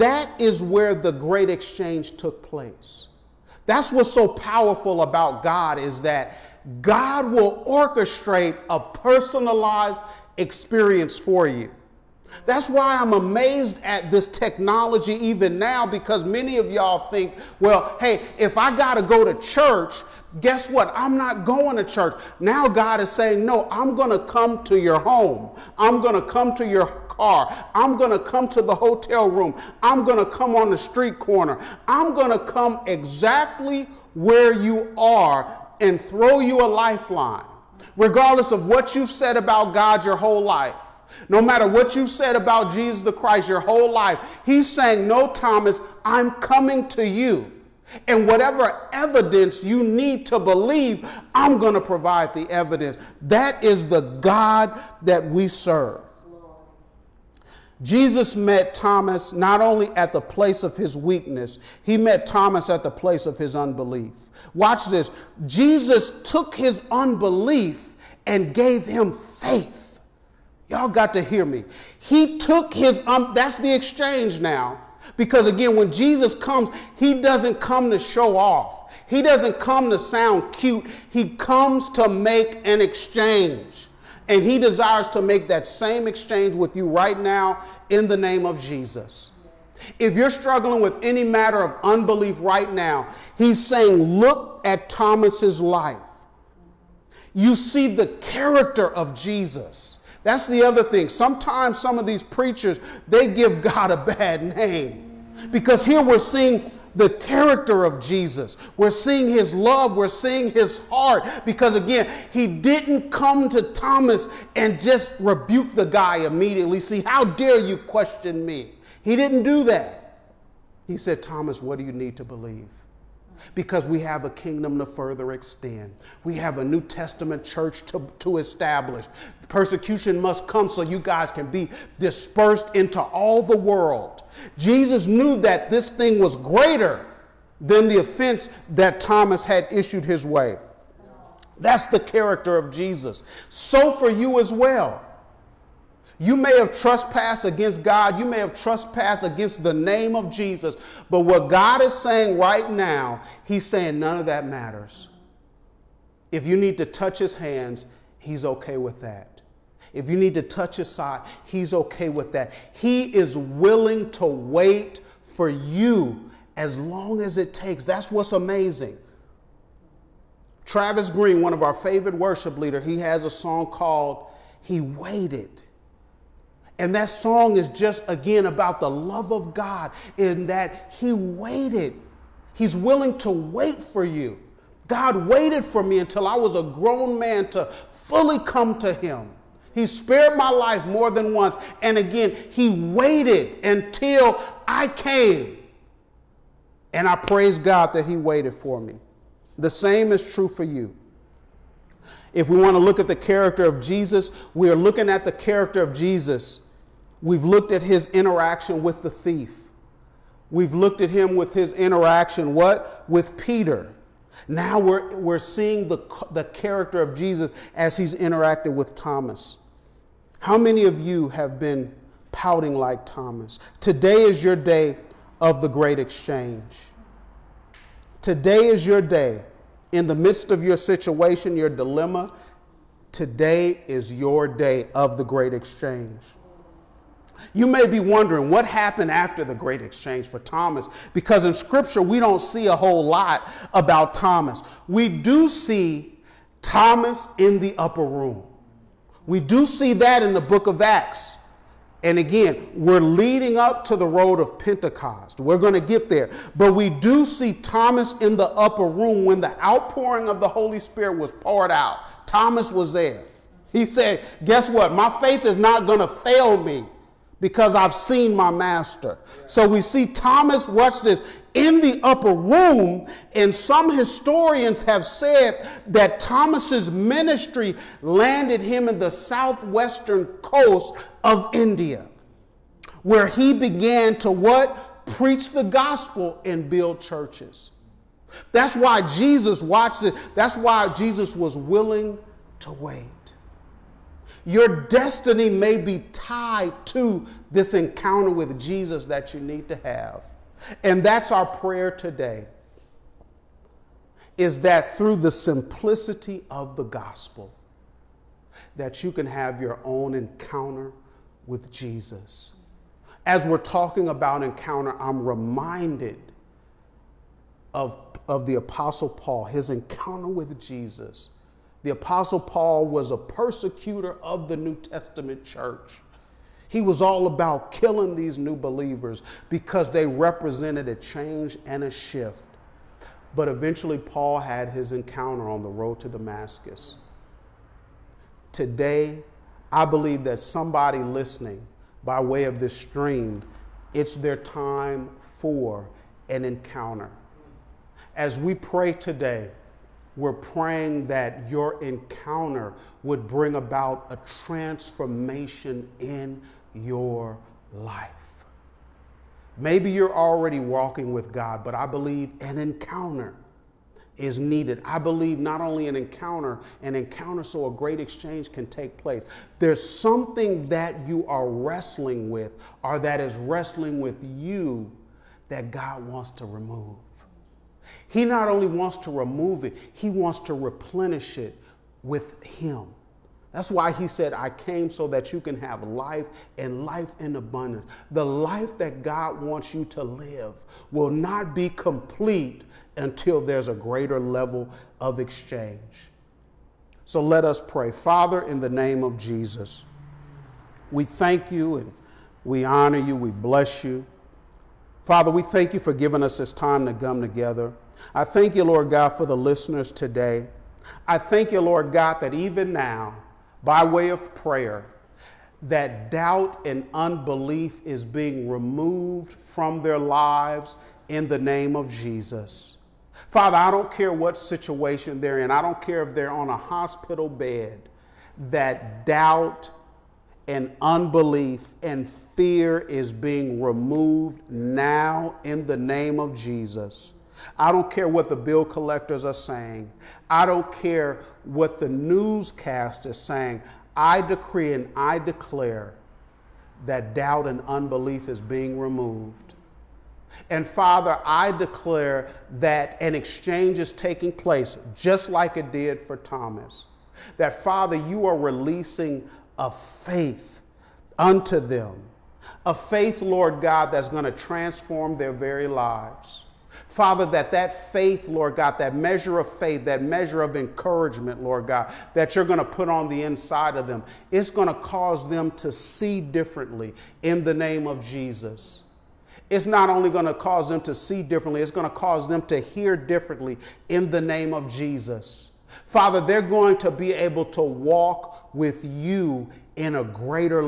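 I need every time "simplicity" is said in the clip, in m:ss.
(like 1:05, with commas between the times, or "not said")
5:05.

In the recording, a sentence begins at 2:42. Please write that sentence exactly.
He is willing to wait for you as long as it takes.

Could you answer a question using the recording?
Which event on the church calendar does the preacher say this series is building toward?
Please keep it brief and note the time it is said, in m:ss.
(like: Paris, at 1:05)
Pentecost, at 4:14.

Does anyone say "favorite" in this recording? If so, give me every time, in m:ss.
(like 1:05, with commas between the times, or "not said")
2:51.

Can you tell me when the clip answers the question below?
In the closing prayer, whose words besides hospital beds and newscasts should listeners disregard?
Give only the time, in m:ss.
7:18.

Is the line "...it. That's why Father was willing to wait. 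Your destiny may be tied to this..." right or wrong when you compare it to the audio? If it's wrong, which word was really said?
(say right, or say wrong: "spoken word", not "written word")
wrong: "Jesus", not "Father".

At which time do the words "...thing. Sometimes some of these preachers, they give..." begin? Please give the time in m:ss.
1:40.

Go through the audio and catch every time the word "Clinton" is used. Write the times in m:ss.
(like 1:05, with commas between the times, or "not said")
not said.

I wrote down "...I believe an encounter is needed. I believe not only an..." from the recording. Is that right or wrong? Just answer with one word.
right.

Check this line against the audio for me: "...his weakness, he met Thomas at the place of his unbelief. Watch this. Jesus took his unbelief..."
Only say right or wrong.
right.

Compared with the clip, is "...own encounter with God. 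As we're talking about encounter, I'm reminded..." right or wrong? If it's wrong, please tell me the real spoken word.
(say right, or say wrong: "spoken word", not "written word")
wrong: "Jesus", not "God".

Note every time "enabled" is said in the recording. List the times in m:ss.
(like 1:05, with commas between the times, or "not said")
not said.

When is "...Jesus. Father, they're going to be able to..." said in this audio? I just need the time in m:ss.
8:04.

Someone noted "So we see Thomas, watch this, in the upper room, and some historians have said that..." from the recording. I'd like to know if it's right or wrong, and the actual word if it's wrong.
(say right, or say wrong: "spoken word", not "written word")
right.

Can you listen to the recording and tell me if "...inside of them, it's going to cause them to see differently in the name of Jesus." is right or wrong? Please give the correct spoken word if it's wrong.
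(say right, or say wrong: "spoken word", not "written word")
right.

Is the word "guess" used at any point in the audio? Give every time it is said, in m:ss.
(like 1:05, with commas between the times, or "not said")
0:20, 4:24.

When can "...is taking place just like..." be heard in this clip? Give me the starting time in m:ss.
7:33.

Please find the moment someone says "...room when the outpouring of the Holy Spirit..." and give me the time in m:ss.
4:18.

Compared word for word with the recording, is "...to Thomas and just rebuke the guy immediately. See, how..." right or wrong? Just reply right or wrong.
right.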